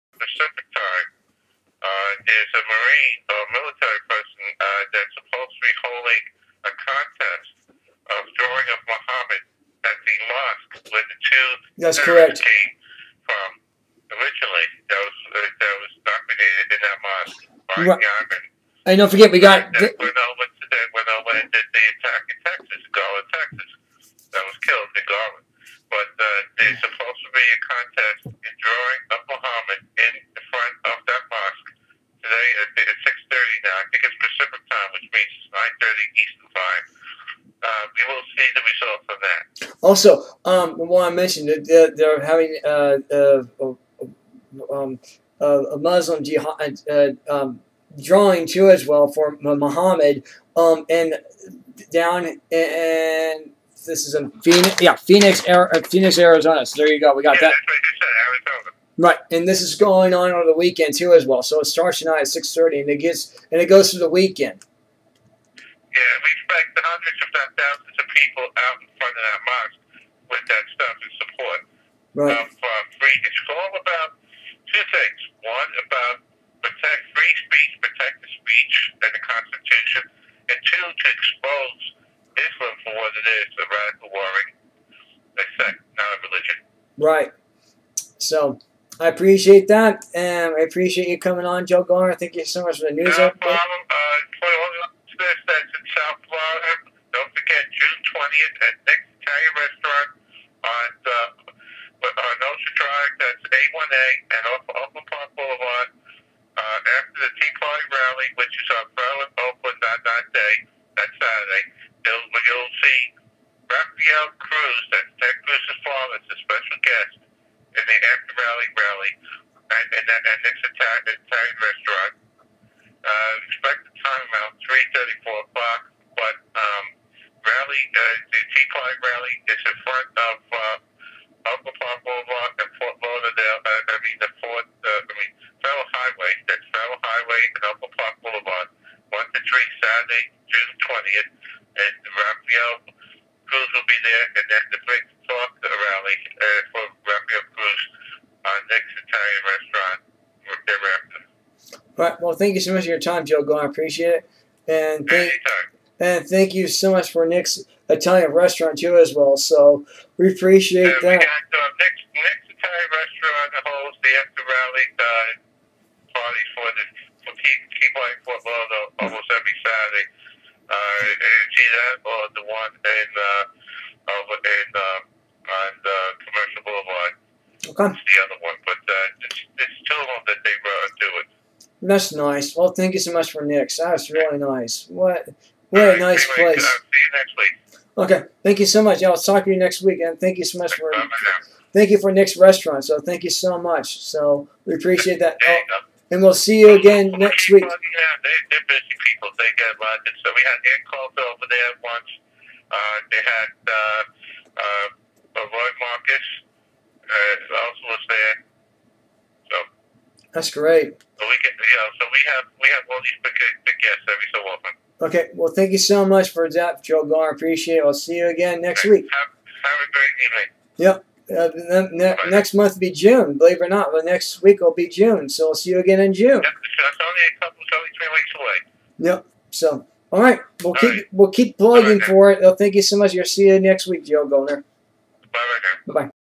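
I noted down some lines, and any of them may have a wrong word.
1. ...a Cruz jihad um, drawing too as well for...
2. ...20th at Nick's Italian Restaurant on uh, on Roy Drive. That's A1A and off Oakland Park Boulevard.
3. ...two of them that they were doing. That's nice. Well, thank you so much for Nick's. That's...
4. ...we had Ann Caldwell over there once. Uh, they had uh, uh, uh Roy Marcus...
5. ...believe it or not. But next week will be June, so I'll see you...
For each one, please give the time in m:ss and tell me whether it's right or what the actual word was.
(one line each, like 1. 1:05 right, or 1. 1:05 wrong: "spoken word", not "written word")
1. 0:45 wrong: "Muslim", not "Cruz"
2. 1:38 wrong: "Ocean", not "Roy"
3. 2:59 right
4. 3:20 right
5. 3:43 right.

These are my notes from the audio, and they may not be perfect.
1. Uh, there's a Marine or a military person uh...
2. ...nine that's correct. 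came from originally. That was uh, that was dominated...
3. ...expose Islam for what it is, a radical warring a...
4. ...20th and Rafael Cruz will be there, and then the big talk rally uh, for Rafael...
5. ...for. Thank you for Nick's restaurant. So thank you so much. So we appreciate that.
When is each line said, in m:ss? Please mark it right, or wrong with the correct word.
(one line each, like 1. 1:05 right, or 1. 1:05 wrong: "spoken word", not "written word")
1. 0:01 right
2. 0:11 wrong: "two", not "nine"
3. 1:21 right
4. 2:20 right
5. 3:10 right.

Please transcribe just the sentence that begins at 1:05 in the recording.
Yeah, we out in front of that mosque with that stuff and support right.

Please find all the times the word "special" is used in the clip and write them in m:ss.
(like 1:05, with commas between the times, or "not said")
1:56.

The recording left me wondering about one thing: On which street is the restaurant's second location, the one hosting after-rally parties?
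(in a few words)
Commercial Boulevard.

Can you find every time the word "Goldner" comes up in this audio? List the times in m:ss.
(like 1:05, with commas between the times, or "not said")
1:31, 3:37, 3:54.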